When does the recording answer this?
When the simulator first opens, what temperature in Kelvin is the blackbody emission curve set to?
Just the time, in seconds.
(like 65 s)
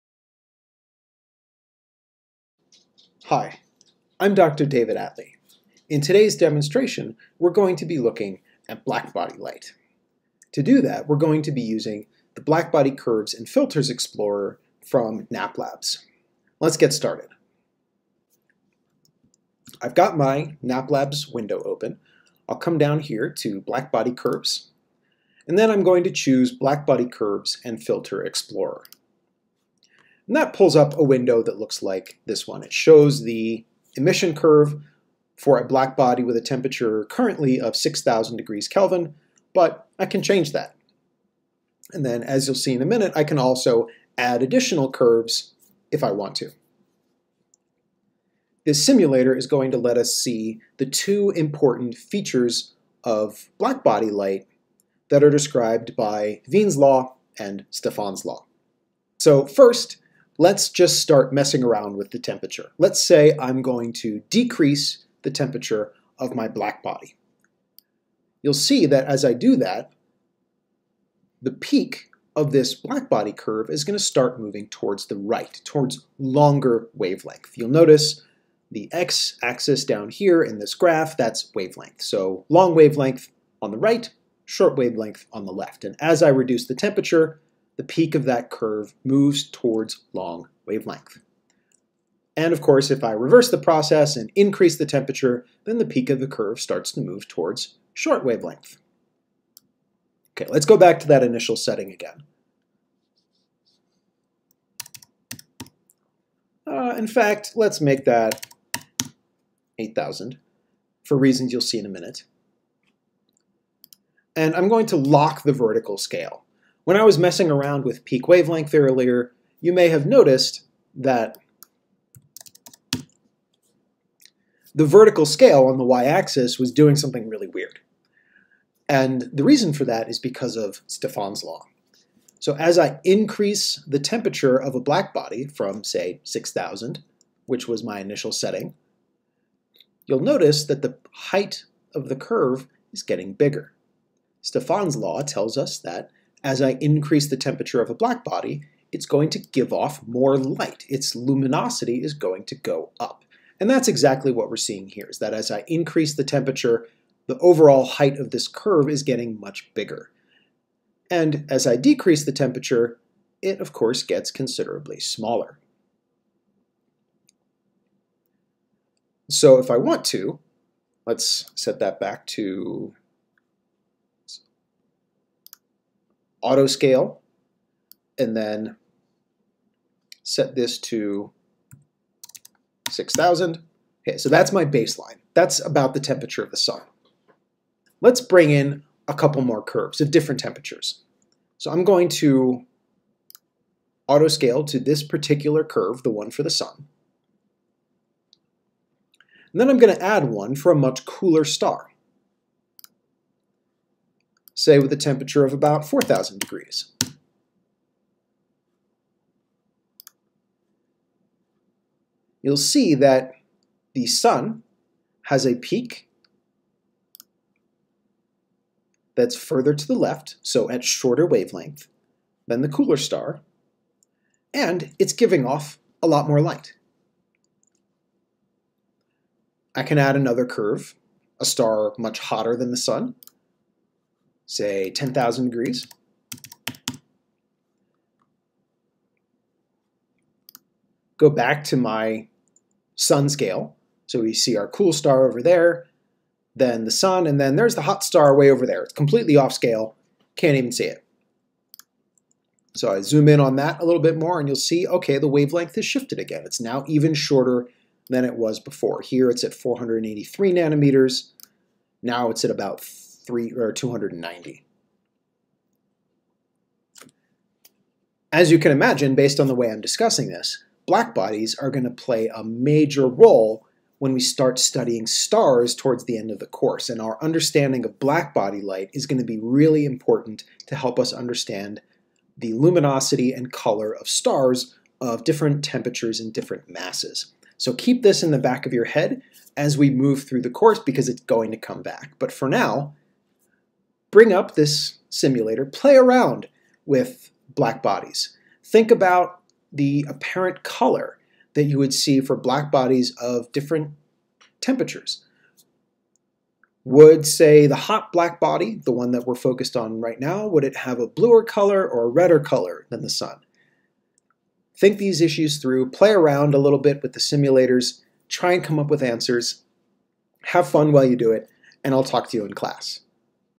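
37 s.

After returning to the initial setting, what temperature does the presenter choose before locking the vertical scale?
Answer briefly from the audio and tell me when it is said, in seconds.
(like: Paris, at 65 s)
8,000, at 109 s.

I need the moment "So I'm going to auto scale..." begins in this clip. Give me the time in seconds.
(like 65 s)
191 s.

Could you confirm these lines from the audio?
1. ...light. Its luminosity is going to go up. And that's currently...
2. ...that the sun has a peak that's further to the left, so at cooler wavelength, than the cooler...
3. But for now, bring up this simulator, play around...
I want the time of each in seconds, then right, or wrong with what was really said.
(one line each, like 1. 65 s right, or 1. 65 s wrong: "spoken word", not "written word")
1. 150 s wrong: "exactly", not "currently"
2. 212 s wrong: "shorter", not "cooler"
3. 292 s right.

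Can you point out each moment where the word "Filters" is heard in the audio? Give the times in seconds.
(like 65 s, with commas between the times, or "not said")
13 s, 27 s.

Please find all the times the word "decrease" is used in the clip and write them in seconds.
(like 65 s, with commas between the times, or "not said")
64 s, 161 s.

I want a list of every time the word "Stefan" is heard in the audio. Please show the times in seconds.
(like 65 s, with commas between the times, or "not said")
57 s, 130 s, 144 s.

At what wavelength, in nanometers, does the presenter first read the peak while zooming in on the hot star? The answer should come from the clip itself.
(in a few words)
483 nanometers.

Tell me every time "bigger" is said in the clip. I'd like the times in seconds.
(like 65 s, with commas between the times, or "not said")
143 s, 159 s.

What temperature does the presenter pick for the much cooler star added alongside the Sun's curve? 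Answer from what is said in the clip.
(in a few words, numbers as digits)
4,000 degrees.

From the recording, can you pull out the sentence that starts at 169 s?
So if I want to, let's set that back to auto scale, and then set this to 6,000.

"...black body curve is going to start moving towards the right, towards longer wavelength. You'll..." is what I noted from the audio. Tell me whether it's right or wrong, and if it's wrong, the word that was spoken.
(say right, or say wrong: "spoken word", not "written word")
right.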